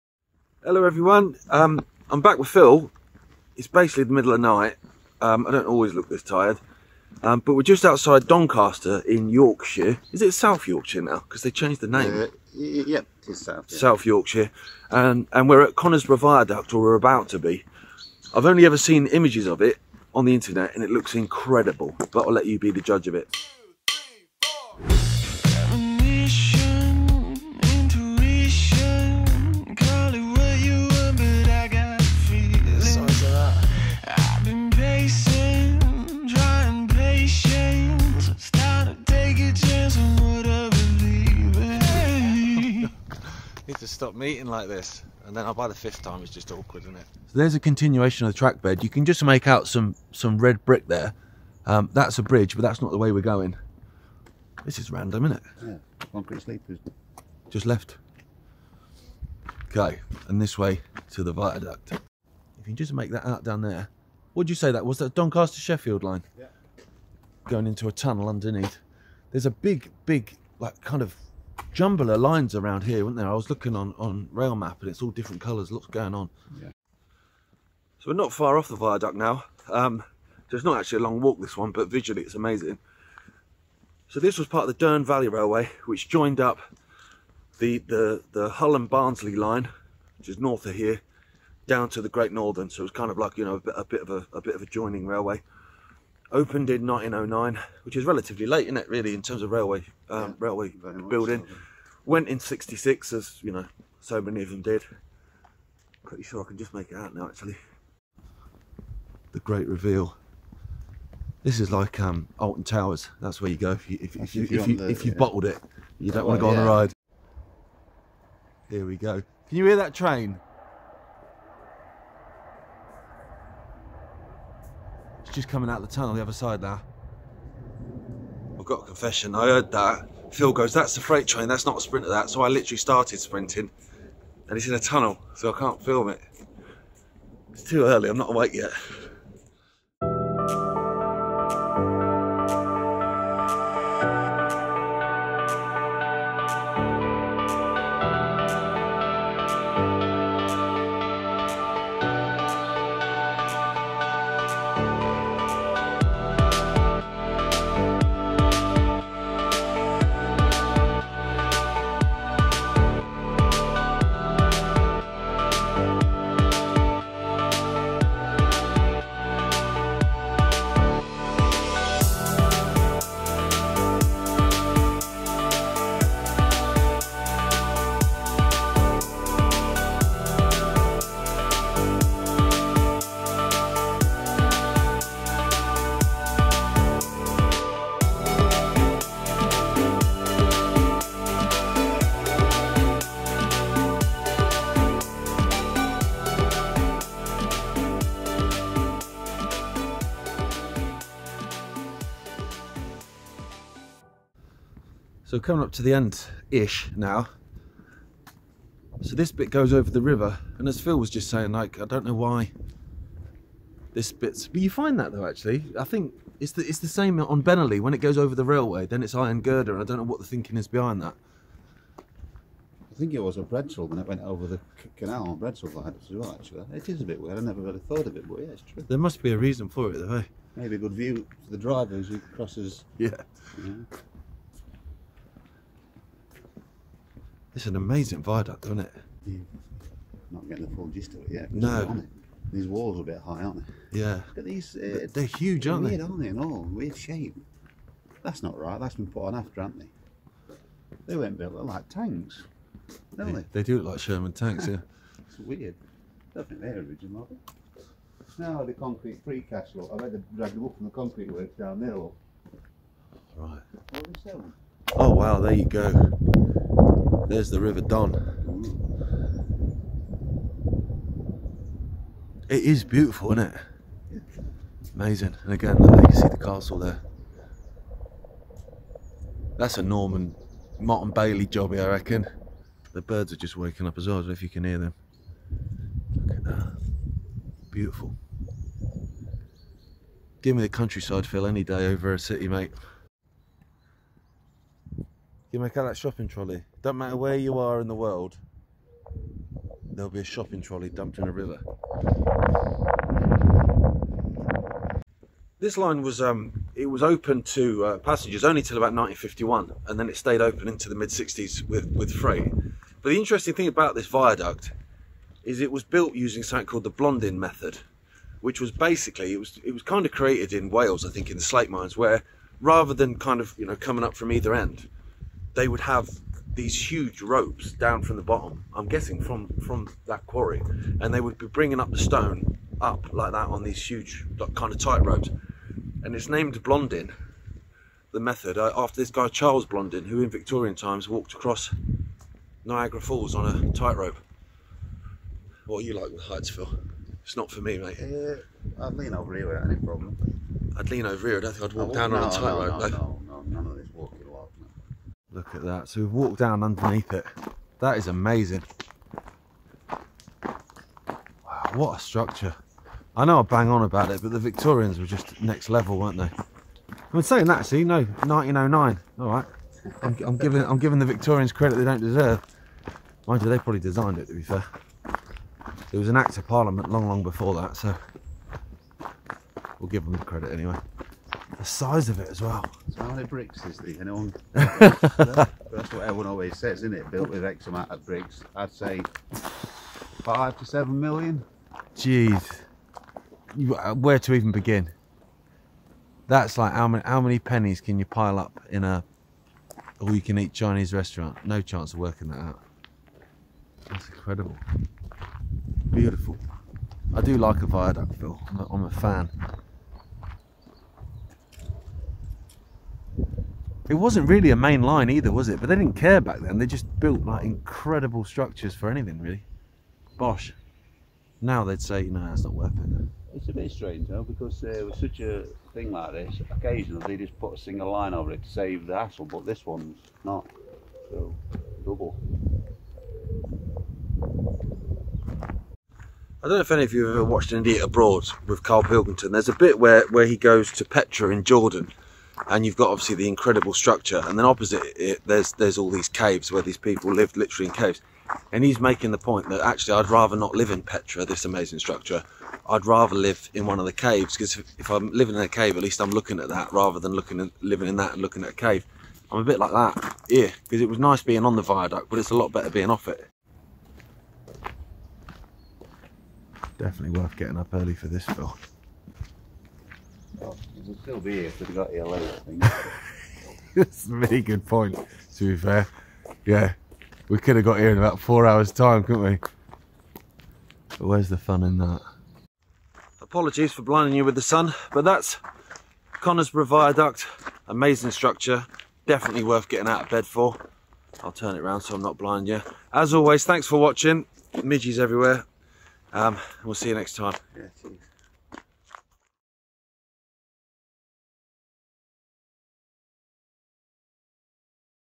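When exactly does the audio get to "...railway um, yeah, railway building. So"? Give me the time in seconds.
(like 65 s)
99 s.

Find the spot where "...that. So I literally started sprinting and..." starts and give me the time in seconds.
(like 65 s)
132 s.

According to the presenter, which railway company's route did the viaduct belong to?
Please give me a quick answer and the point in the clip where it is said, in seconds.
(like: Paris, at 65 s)
Dearne Valley Railway, at 84 s.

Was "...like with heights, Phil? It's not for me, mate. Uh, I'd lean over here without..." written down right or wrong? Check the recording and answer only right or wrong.
right.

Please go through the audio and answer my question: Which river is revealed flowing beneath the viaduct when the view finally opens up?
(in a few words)
River Don.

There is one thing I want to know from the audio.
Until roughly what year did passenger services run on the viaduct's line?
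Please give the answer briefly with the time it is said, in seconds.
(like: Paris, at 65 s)
1951, at 308 s.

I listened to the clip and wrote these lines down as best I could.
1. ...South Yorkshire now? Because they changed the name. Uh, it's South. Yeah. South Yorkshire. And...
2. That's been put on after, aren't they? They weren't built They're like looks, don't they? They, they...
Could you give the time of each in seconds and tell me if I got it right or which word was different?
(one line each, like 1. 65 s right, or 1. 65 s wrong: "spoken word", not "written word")
1. 10 s right
2. 248 s wrong: "tanks", not "looks".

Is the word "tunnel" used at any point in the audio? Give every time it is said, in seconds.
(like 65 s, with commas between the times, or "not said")
67 s, 125 s, 134 s.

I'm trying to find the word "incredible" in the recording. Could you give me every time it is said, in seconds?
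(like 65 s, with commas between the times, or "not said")
21 s, 404 s, 417 s, 443 s.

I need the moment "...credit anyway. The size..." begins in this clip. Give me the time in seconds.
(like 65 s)
380 s.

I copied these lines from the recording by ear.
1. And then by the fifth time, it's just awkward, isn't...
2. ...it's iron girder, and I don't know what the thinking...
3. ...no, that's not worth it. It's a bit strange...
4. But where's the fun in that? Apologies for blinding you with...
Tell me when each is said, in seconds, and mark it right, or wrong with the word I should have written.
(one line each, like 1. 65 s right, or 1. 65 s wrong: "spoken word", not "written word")
1. 45 s right
2. 219 s right
3. 422 s right
4. 480 s right.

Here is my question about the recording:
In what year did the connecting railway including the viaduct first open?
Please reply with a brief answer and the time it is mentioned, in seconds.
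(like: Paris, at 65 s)
1909, at 96 s.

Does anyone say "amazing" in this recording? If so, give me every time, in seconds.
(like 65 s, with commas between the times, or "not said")
82 s, 237 s, 274 s, 358 s, 451 s, 487 s.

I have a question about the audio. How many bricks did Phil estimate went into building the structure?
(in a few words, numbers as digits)
5 to 7 million.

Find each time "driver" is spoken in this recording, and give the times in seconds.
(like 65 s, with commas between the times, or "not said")
231 s.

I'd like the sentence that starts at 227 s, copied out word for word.
I never really thought of it, but yeah, it's true.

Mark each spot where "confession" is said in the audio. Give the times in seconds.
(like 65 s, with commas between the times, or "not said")
128 s.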